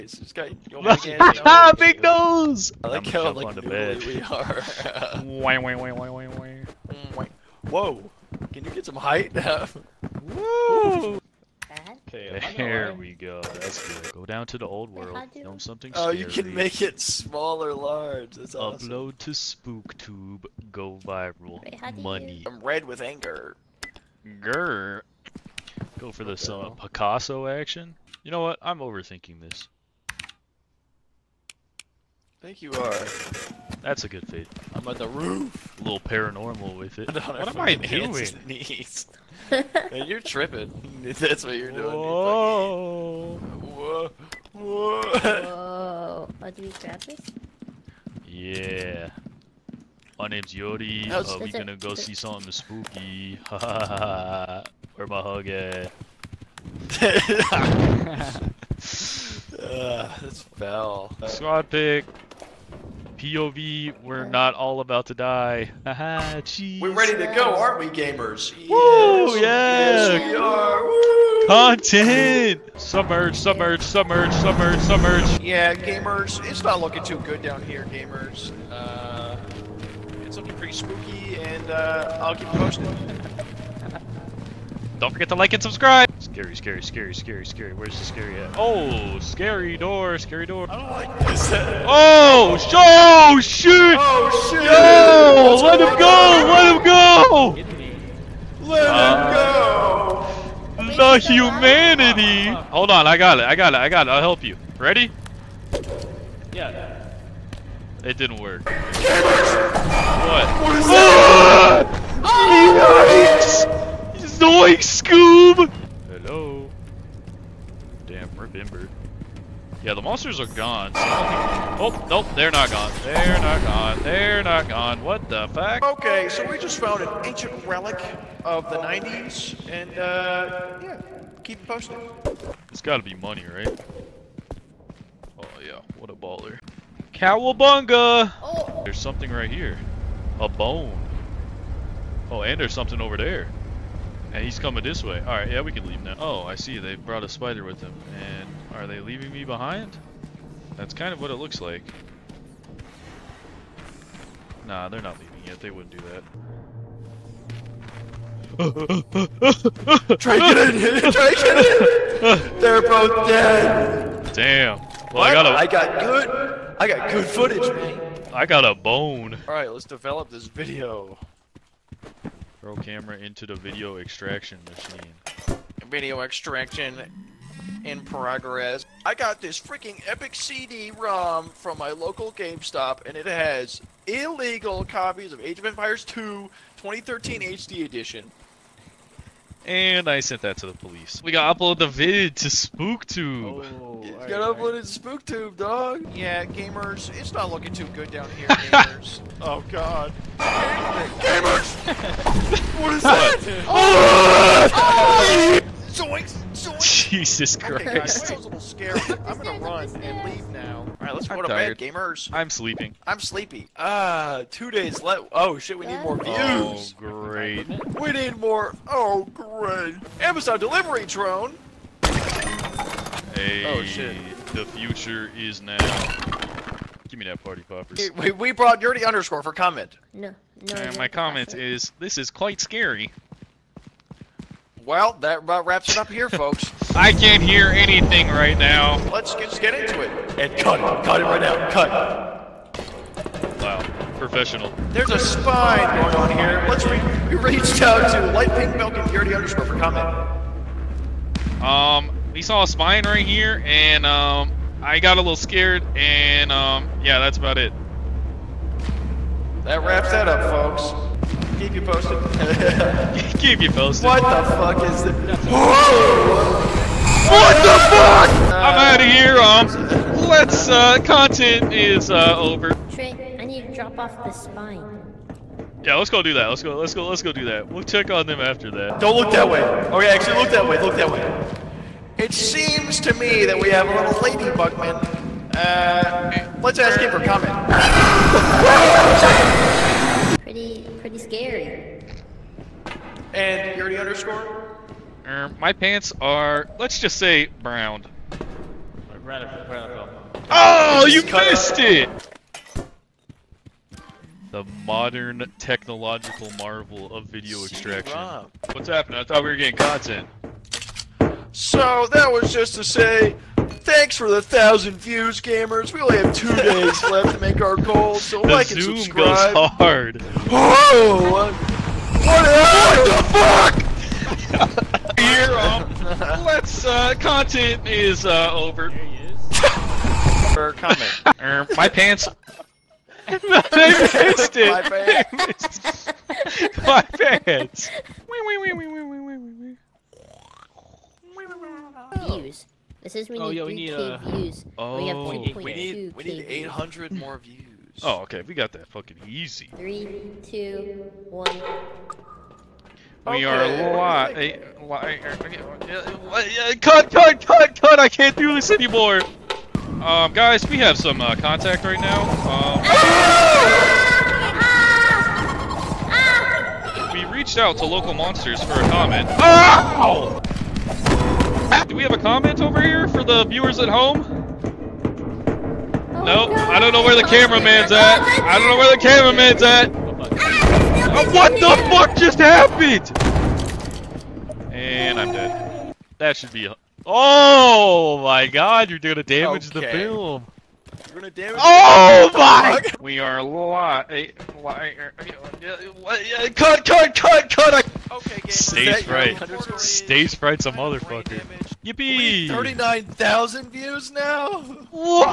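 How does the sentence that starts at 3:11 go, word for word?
We gotta upload the vid to SpookTube.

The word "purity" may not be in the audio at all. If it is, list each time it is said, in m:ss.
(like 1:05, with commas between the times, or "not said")
4:09, 4:53.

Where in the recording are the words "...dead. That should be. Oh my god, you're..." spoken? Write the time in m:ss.
6:25.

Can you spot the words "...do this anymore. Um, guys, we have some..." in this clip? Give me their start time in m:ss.
5:58.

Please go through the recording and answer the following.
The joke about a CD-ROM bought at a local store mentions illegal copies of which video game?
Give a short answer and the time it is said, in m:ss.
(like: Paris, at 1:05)
Age of Empires 2, at 3:05.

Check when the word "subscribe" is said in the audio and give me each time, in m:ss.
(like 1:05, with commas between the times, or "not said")
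1:25, 5:18.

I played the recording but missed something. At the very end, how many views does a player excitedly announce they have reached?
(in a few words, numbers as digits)
39,000.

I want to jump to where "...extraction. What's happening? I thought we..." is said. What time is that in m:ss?
5:07.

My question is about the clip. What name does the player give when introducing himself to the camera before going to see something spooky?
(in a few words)
Yori.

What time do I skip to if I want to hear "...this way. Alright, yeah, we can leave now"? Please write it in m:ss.
2:24.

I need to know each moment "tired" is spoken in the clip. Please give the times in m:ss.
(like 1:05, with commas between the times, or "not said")
3:31.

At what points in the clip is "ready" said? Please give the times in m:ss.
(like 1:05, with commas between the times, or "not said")
1:06, 1:44.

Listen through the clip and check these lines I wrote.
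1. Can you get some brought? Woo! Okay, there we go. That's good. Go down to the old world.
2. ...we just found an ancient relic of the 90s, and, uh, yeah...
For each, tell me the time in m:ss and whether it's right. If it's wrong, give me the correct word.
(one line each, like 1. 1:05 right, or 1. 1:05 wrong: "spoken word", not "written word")
1. 0:08 wrong: "height", not "brought"
2. 2:06 right.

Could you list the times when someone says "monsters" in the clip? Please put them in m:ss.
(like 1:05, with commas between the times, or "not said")
2:00, 6:08.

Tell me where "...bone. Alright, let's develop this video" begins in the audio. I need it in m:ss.
2:48.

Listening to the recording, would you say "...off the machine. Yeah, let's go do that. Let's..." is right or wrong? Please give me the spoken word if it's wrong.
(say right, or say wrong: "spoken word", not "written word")
wrong: "spine", not "machine".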